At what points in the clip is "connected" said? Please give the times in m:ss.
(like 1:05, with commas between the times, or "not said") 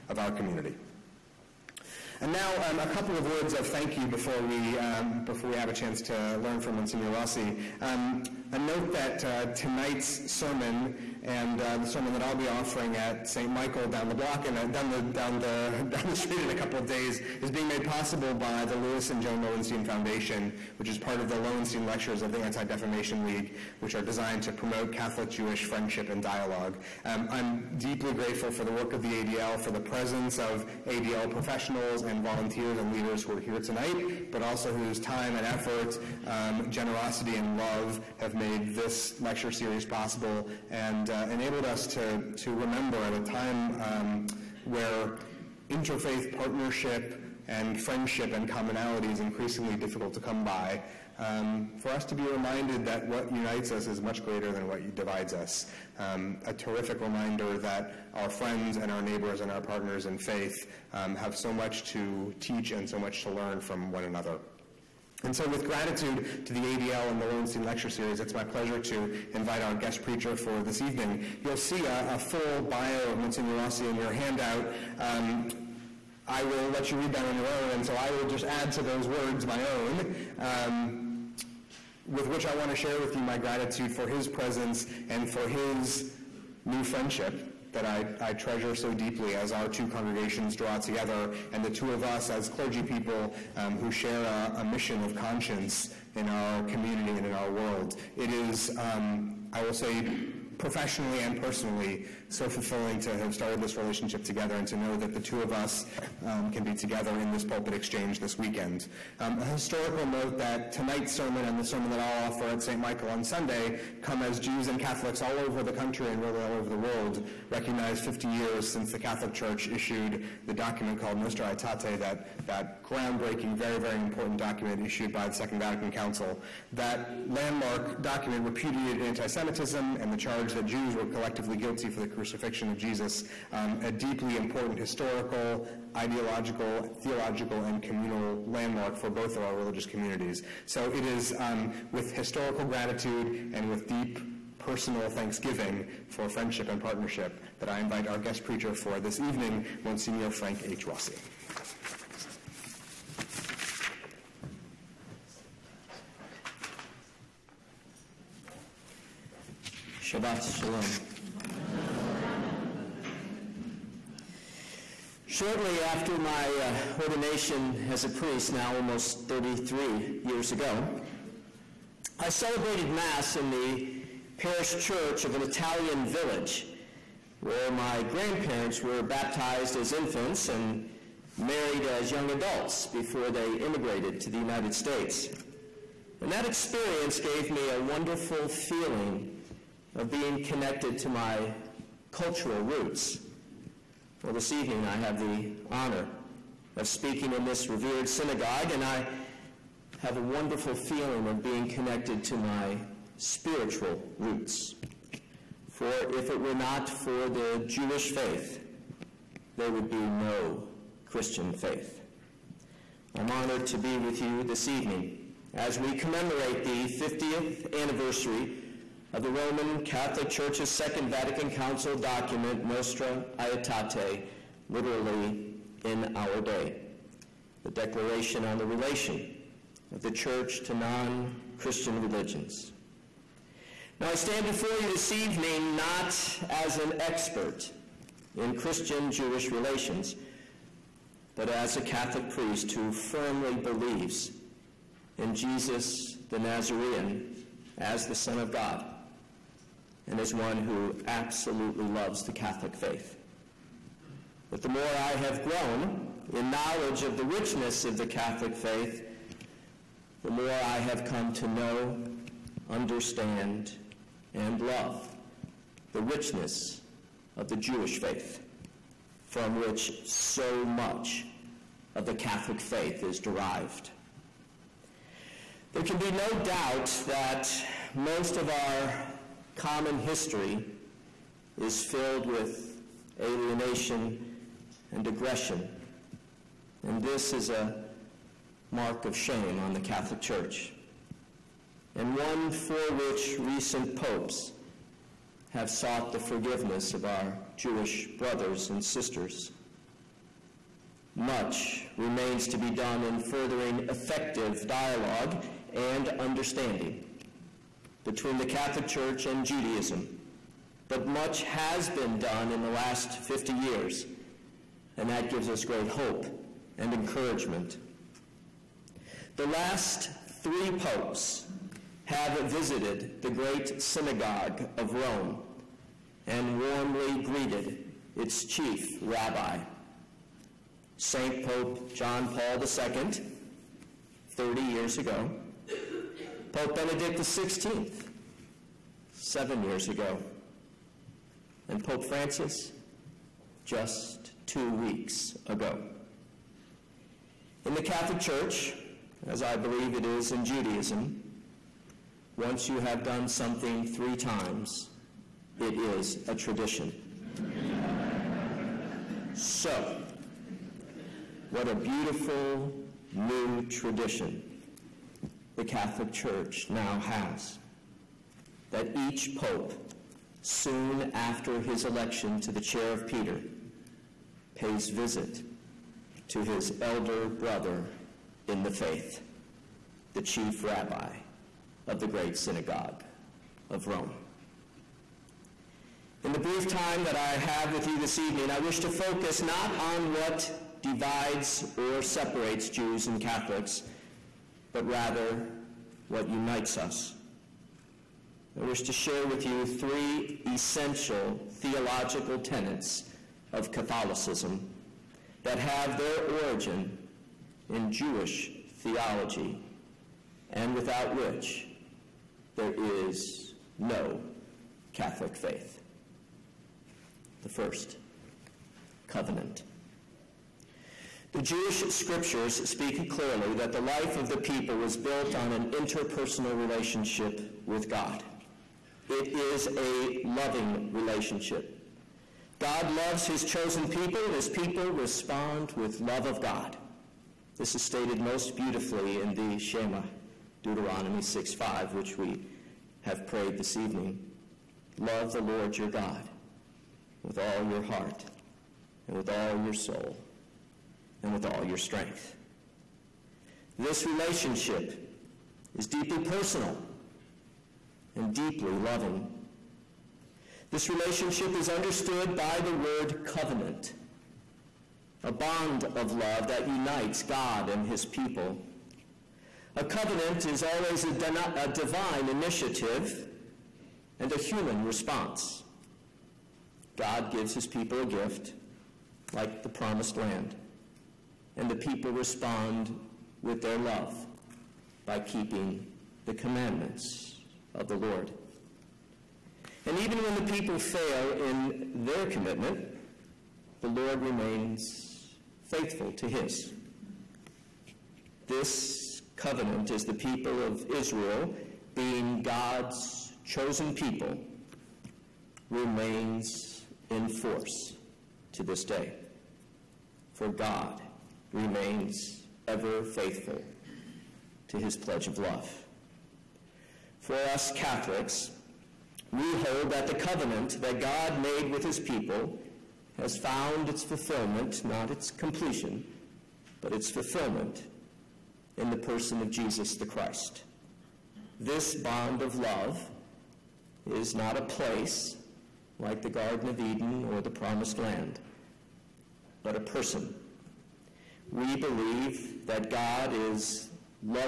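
3:10, 3:21.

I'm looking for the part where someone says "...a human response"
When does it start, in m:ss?
7:54.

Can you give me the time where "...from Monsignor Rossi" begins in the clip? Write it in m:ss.
0:06.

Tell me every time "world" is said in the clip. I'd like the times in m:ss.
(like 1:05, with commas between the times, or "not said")
1:37, 1:56.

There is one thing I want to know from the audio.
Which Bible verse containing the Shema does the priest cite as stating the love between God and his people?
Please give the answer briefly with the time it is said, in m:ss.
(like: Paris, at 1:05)
Deuteronomy 6:5, at 7:20.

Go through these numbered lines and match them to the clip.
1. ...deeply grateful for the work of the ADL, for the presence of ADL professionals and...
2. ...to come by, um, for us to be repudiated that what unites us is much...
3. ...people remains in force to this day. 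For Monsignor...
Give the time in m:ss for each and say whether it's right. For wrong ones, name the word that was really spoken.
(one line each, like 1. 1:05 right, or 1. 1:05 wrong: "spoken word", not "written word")
1. 0:27 right
2. 0:50 wrong: "reminded", not "repudiated"
3. 8:23 wrong: "God", not "Monsignor".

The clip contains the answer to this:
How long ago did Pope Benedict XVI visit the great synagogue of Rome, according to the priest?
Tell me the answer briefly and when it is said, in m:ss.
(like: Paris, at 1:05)
7 years, at 5:39.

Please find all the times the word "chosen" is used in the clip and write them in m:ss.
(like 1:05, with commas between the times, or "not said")
7:13, 8:23.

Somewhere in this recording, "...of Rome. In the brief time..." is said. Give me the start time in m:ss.
6:23.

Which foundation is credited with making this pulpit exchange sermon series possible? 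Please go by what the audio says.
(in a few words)
Lewis and Joan Lowenstein Foundation.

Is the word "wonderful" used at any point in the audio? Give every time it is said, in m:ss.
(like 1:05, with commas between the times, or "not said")
3:07, 3:20.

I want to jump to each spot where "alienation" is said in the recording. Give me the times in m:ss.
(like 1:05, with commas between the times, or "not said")
4:43.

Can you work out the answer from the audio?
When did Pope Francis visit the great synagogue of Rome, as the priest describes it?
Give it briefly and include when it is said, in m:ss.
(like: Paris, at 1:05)
2 weeks ago, at 5:44.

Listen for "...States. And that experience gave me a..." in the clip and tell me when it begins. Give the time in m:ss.
3:04.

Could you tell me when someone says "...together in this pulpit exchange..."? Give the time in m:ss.
1:46.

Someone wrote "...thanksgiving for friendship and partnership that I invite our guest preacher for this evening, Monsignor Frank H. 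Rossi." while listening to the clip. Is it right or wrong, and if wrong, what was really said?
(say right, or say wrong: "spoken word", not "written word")
right.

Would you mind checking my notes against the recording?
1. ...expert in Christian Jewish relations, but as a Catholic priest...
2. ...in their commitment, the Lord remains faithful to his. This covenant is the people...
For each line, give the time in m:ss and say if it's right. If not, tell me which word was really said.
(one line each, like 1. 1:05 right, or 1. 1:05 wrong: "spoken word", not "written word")
1. 3:56 right
2. 8:11 right.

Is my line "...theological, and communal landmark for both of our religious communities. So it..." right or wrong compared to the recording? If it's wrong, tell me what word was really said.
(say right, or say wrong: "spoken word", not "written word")
right.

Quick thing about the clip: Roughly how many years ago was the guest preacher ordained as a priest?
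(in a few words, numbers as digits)
33.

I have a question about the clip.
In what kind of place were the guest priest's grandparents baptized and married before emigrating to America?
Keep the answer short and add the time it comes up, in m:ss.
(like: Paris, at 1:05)
Italian village, at 2:55.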